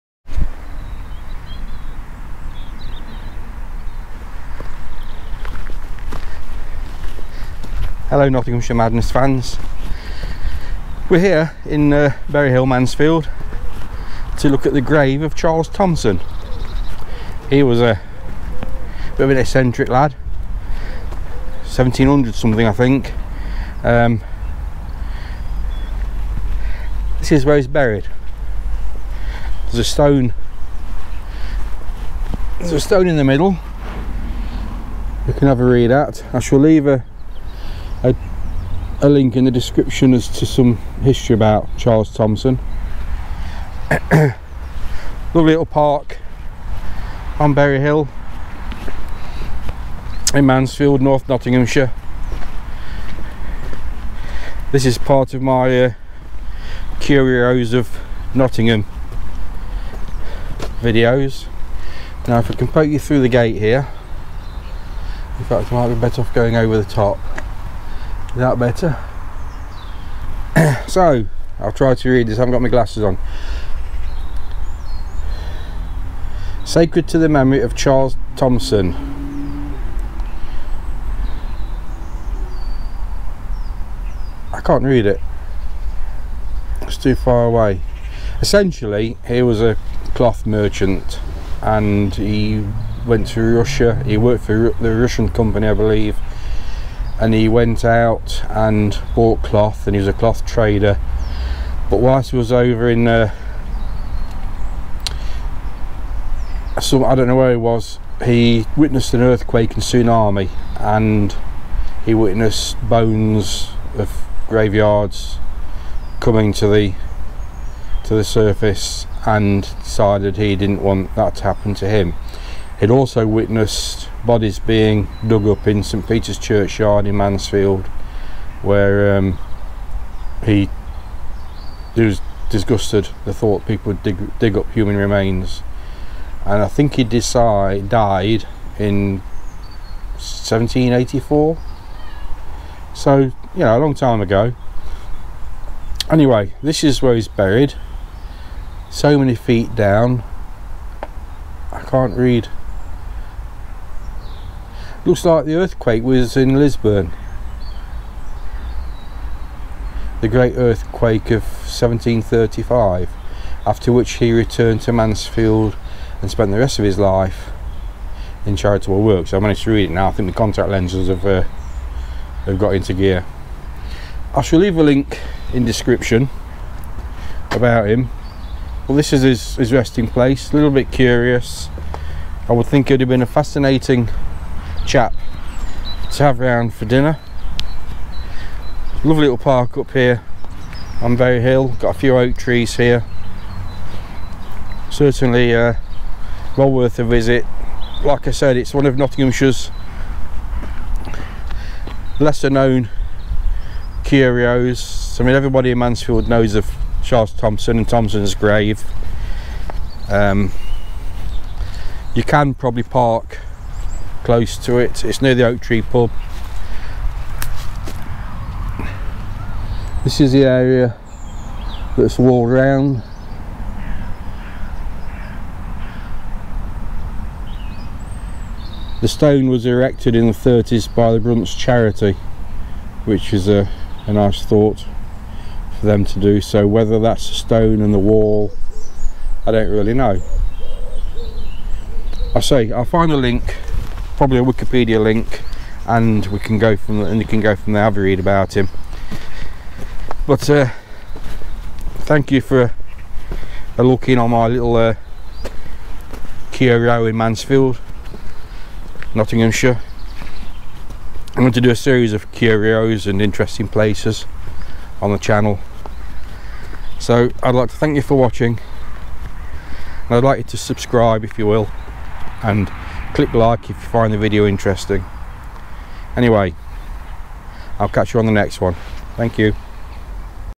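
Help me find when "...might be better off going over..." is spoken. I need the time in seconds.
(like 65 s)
65 s.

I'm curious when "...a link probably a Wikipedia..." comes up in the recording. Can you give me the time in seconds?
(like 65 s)
243 s.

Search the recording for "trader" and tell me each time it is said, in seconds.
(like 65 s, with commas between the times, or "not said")
100 s.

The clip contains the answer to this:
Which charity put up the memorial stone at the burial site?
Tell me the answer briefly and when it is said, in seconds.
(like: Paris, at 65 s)
Brunt's Charity, at 231 s.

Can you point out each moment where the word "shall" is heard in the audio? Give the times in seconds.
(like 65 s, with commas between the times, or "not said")
36 s, 174 s.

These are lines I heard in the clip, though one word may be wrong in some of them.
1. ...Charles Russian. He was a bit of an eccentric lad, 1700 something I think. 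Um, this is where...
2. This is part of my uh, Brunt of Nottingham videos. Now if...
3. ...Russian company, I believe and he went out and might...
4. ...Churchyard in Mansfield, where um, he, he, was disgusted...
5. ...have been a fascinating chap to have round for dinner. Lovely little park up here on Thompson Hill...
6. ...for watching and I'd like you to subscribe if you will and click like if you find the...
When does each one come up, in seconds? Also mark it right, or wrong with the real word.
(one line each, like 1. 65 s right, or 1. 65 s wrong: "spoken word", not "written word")
1. 15 s wrong: "Thompson", not "Russian"
2. 54 s wrong: "Curios", not "Brunt"
3. 94 s wrong: "bought", not "might"
4. 126 s right
5. 183 s wrong: "Berry", not "Thompson"
6. 268 s right.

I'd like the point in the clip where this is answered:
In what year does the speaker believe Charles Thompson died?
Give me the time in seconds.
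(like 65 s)
140 s.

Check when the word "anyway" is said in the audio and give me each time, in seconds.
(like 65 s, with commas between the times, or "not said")
146 s, 276 s.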